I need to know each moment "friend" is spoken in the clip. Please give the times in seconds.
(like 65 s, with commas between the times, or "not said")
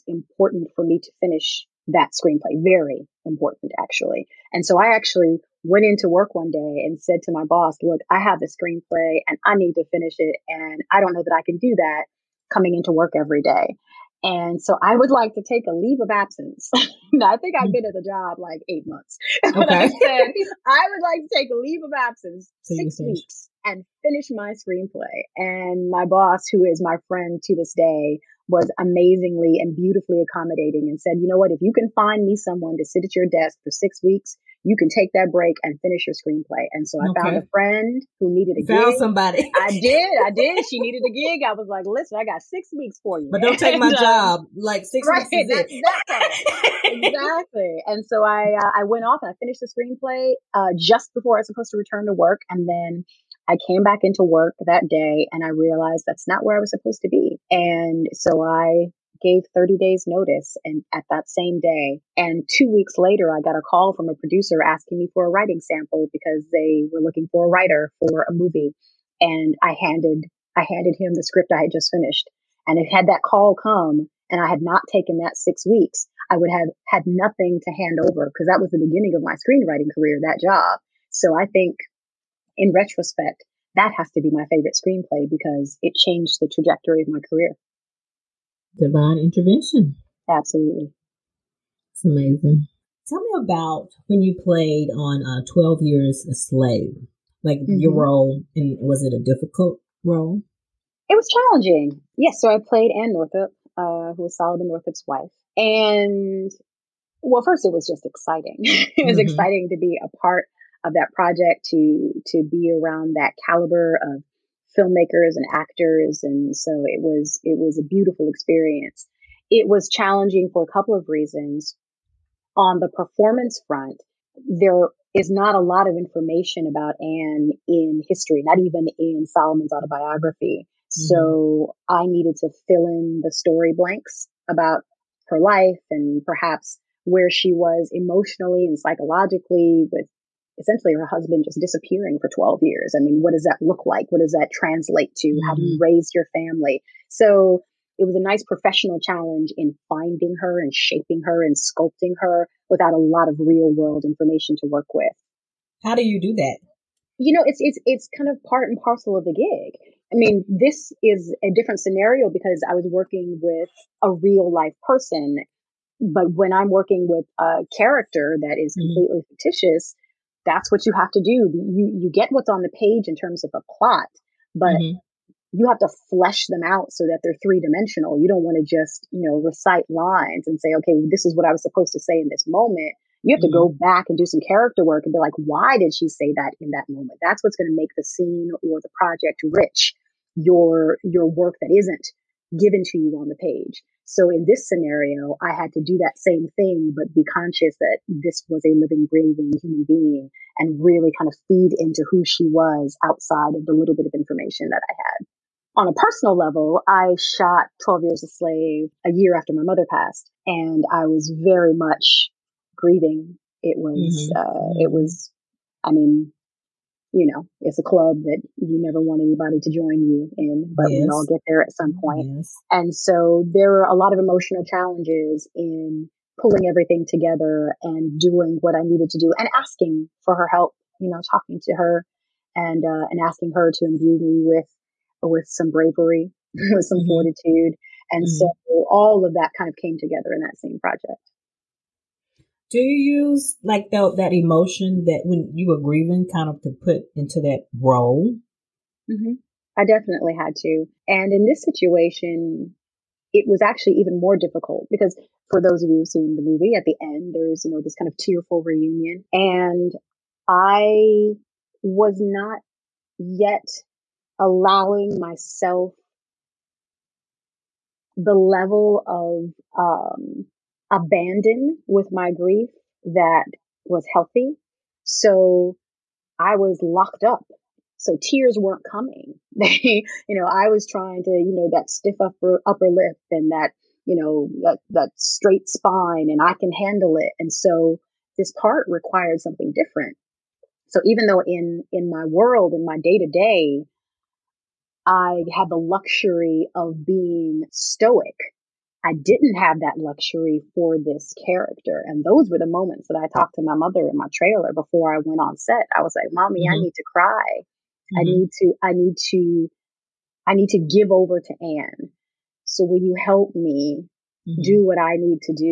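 27 s, 37 s.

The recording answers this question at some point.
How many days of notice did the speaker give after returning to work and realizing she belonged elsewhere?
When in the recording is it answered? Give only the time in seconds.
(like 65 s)
59 s.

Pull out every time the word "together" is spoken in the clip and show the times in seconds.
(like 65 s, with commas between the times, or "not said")
227 s, 239 s.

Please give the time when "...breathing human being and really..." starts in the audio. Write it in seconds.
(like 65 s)
199 s.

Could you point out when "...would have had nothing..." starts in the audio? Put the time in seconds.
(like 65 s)
76 s.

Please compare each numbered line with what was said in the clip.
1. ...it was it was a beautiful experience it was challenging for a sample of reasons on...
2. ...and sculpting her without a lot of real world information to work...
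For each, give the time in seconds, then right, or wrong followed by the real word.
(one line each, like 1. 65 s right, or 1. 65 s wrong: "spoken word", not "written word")
1. 116 s wrong: "couple", not "sample"
2. 151 s right.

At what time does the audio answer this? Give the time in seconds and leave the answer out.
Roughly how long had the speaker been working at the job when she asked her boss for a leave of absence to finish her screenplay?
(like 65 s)
18 s.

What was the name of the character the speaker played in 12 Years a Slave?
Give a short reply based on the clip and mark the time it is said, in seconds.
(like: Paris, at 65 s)
Anne Northup, at 102 s.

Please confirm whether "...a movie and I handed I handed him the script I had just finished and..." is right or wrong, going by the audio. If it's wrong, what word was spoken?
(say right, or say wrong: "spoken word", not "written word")
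right.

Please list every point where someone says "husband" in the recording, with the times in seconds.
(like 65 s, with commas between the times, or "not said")
141 s.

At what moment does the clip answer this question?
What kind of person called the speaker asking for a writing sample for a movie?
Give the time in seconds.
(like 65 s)
64 s.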